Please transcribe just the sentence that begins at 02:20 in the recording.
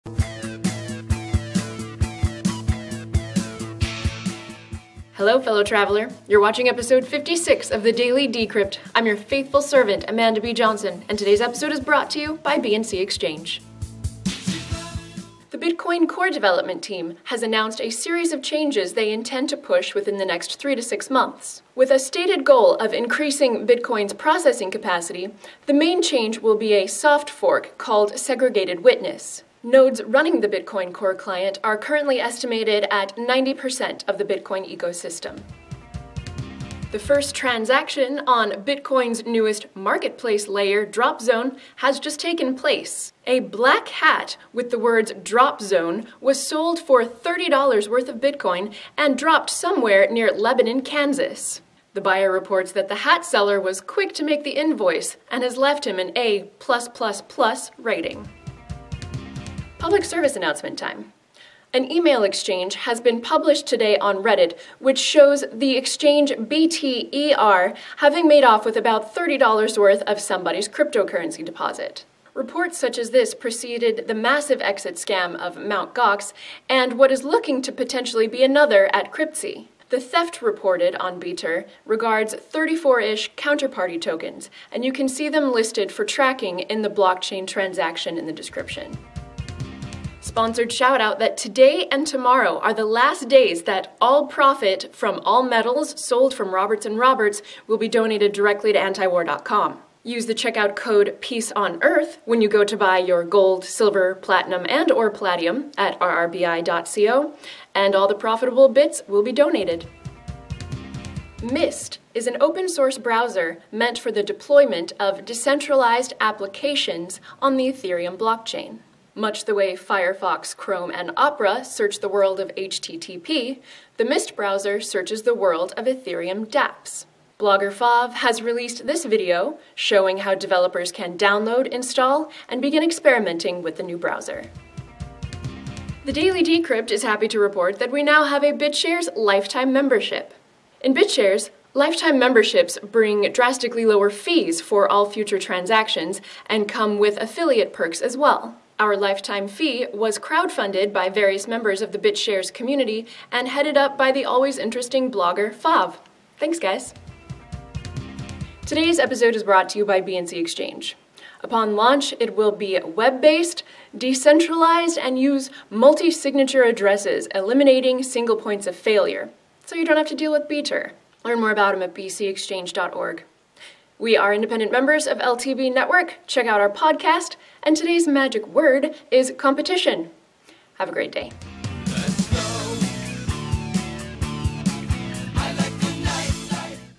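In BitShares, lifetime memberships bring drastically lower fees for all future transactions and come with affiliate perks as well.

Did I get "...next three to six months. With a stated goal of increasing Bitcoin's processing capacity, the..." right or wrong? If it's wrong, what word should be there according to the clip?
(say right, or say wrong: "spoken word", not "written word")
right.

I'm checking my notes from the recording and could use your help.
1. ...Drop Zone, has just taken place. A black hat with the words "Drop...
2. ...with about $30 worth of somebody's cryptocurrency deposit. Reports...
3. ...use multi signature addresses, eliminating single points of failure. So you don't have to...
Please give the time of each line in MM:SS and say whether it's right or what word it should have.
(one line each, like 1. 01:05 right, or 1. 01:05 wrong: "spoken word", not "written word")
1. 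00:40 right
2. 01:08 right
3. 02:45 right.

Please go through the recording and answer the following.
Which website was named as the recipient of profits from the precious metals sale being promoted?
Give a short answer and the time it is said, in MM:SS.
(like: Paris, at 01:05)
antiwar.com, at 01:38.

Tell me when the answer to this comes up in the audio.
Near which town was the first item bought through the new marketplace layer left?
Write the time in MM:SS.
00:50.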